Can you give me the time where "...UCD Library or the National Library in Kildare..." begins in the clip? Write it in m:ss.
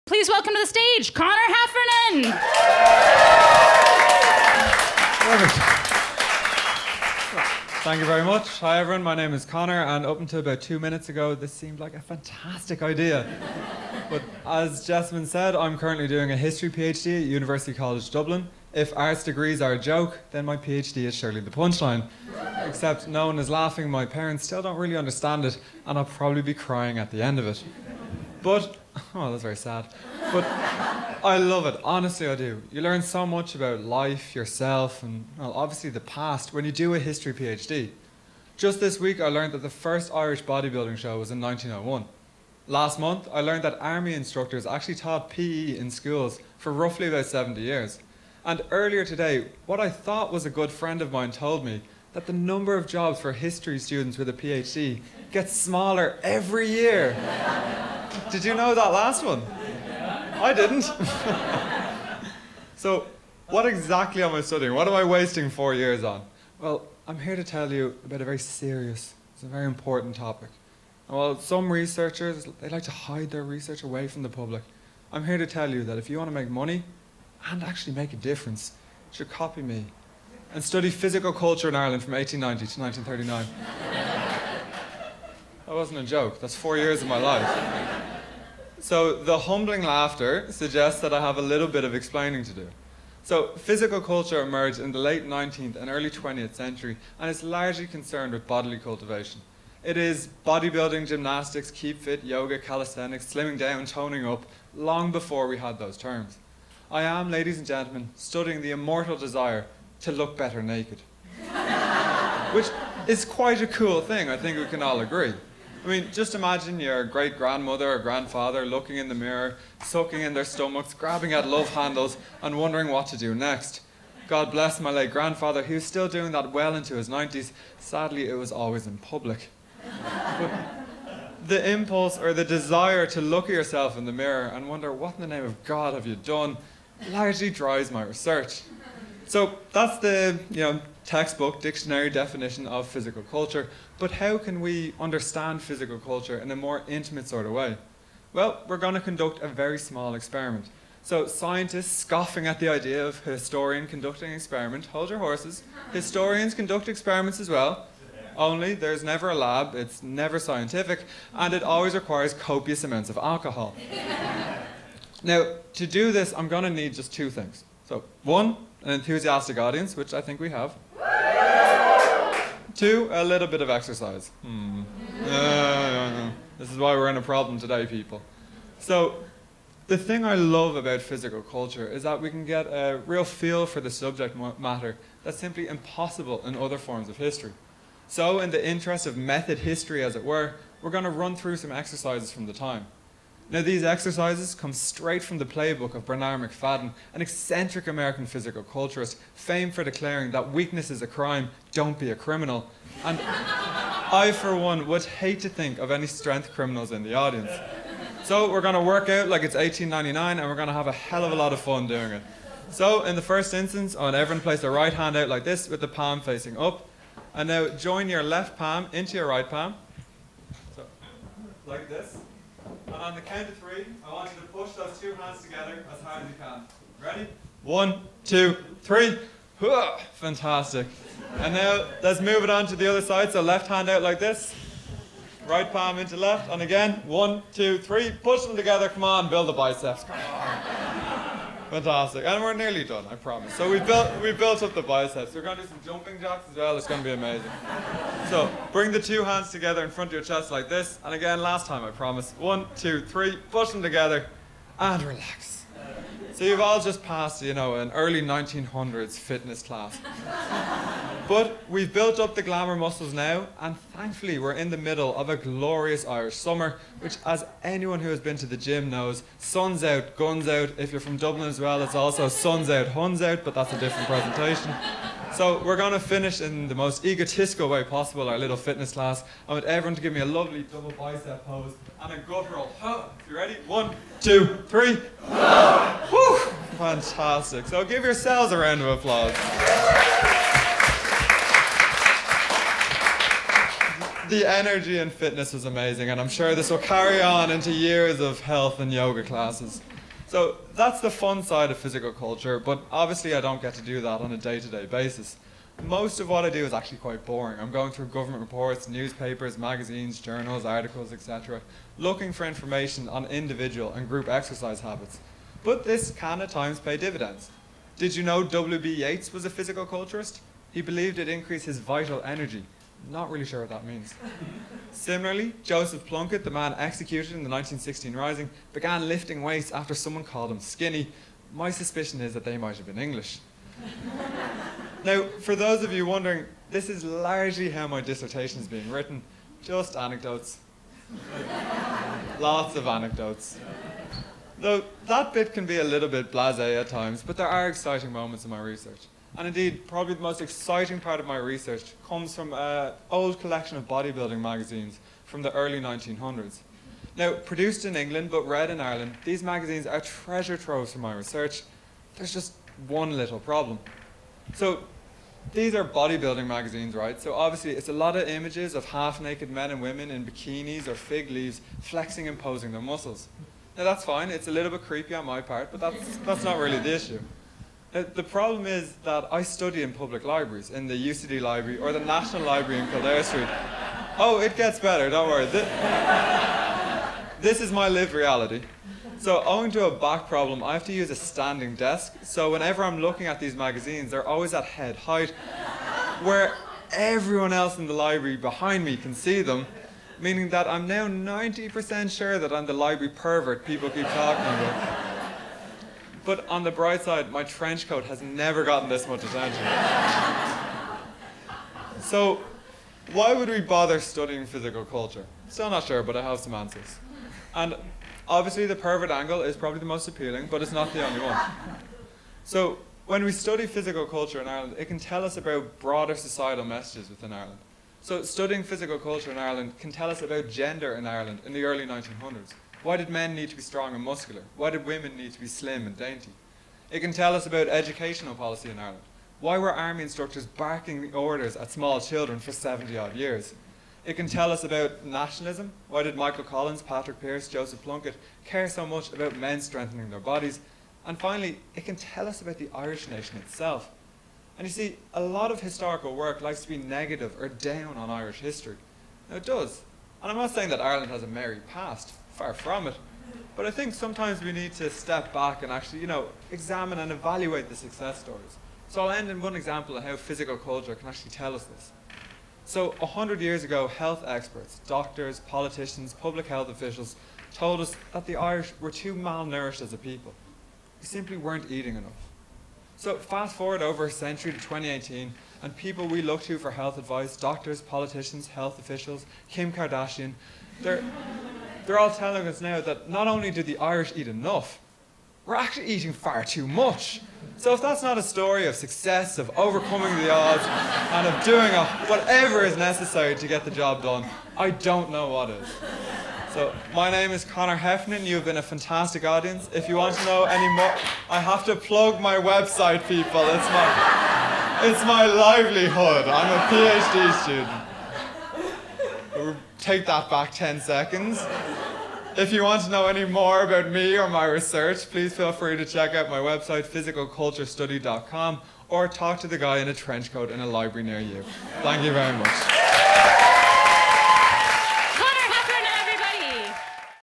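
6:21.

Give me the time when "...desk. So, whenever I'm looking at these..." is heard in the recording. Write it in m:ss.
6:31.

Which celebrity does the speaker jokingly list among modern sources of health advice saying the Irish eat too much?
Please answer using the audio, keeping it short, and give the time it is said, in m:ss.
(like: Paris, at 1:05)
Kim Kardashian, at 8:09.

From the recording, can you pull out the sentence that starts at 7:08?
So, studying physical culture in Ireland can tell us about gender in Ireland in the early 1900s.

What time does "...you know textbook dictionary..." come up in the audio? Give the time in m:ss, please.
2:20.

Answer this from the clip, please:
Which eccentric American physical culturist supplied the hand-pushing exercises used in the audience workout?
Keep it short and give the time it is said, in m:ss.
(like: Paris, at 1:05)
Bernard Macfadden, at 3:16.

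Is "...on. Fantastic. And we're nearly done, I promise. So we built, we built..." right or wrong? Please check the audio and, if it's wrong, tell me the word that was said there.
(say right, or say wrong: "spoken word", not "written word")
right.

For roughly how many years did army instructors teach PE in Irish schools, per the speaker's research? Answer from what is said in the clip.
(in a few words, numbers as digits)
70 years.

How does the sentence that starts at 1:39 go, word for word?
It is bodybuilding, gymnastics, keep fit, yoga, calisthenics, slimming down, toning up, long before we had those terms.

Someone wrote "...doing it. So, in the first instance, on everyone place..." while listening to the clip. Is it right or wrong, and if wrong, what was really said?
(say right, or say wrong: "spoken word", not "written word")
right.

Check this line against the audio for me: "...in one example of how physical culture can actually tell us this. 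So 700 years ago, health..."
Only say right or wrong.
wrong.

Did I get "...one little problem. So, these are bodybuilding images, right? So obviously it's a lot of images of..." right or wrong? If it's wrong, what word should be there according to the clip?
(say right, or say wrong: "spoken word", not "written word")
wrong: "magazines", not "images".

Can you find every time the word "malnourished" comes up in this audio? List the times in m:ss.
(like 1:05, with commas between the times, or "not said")
7:59.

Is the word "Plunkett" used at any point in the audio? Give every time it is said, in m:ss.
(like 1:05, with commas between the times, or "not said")
5:26, 7:27.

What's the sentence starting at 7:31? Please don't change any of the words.
And finally, it can tell us about the Irish nation itself.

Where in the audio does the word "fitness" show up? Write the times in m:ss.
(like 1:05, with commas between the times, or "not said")
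4:19, 4:38, 4:55.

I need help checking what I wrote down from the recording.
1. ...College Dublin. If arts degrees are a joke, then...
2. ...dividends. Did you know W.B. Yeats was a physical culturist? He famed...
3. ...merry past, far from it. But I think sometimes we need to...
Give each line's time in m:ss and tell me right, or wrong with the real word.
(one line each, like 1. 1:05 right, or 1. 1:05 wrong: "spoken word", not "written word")
1. 0:17 right
2. 5:16 wrong: "believed", not "famed"
3. 7:41 right.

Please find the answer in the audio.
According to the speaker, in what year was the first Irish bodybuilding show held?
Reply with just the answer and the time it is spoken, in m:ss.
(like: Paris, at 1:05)
1901, at 0:41.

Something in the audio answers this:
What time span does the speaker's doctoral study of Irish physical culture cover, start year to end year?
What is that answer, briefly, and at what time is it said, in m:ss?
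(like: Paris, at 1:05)
1890 to 1939, at 1:22.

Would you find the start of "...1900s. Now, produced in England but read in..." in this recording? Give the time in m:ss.
5:55.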